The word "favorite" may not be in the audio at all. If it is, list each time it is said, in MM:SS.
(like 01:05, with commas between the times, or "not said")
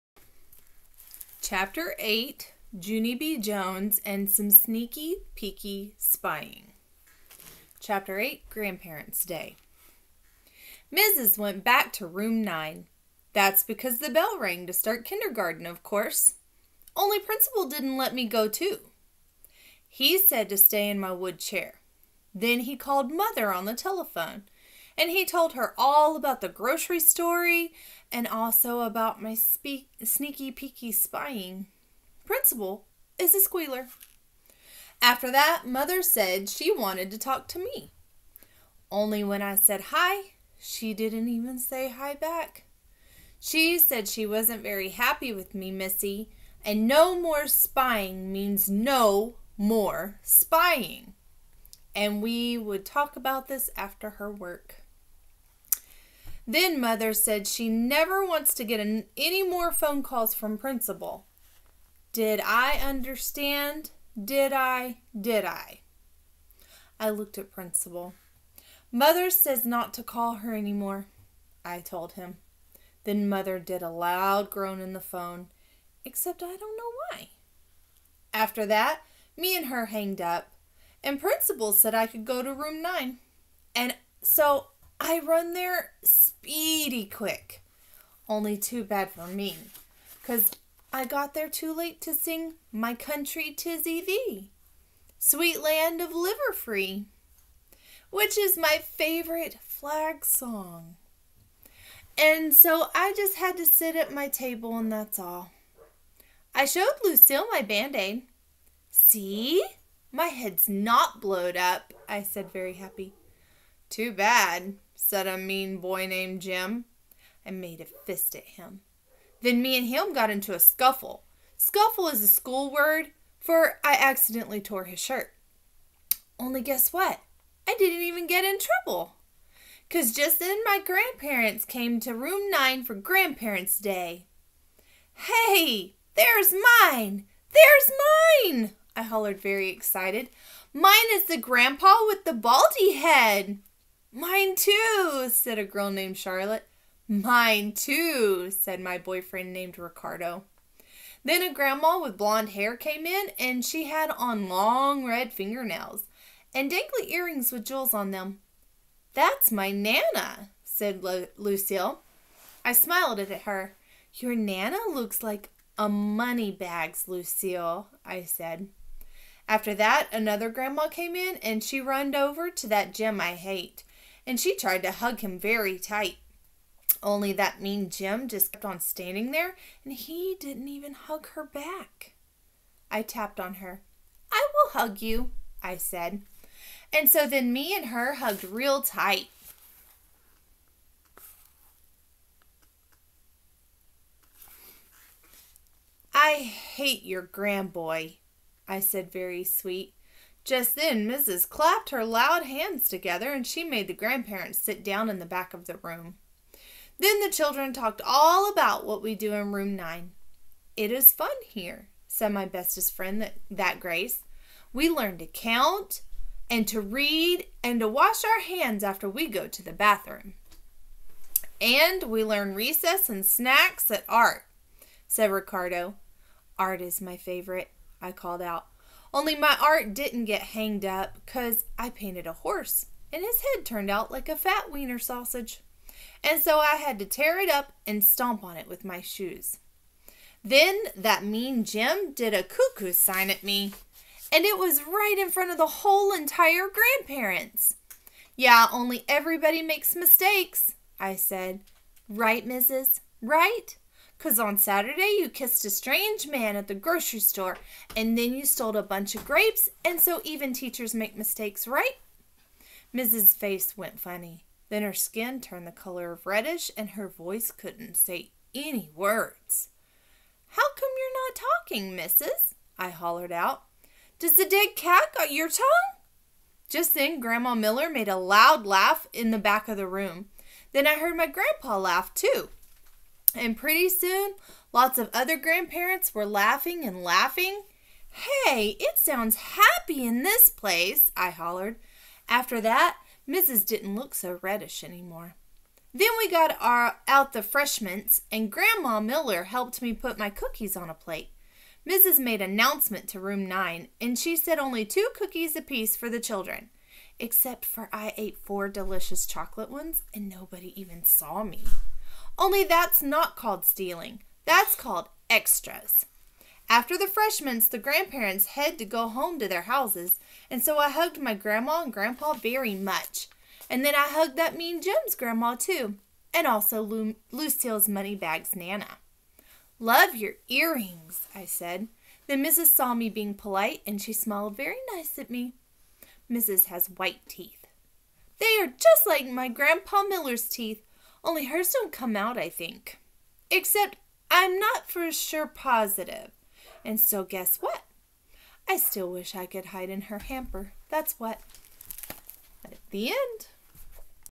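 01:38, 03:47.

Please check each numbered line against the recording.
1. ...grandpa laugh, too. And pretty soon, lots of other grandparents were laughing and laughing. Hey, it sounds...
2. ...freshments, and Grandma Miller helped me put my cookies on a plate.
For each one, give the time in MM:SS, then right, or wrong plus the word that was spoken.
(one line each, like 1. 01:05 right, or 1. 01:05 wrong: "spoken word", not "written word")
1. 04:41 right
2. 04:57 right.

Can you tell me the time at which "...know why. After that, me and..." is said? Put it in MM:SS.
01:16.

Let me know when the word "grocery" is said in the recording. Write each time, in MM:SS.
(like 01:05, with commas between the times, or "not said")
00:26, 04:16.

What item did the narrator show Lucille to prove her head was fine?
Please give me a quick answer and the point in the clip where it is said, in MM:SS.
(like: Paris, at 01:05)
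Band aid, at 01:47.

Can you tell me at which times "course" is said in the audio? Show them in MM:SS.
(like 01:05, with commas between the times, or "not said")
00:15.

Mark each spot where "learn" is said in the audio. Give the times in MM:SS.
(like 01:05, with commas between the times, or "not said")
03:34, 03:42.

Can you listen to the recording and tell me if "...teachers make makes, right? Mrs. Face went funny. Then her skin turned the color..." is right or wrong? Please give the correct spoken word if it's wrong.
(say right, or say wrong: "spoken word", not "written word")
wrong: "mistakes", not "makes".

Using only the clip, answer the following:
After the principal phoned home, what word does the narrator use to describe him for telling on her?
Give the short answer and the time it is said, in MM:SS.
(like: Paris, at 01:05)
Squealer, at 00:32.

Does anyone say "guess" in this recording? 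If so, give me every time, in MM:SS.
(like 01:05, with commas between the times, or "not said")
02:06, 05:47.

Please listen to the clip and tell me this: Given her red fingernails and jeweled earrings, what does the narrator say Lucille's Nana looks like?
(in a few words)
A money bags.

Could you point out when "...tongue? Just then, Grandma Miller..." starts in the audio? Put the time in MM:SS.
04:35.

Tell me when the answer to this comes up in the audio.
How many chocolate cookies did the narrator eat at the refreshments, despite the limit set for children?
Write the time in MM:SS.
05:08.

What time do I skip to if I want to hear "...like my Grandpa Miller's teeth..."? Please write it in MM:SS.
05:39.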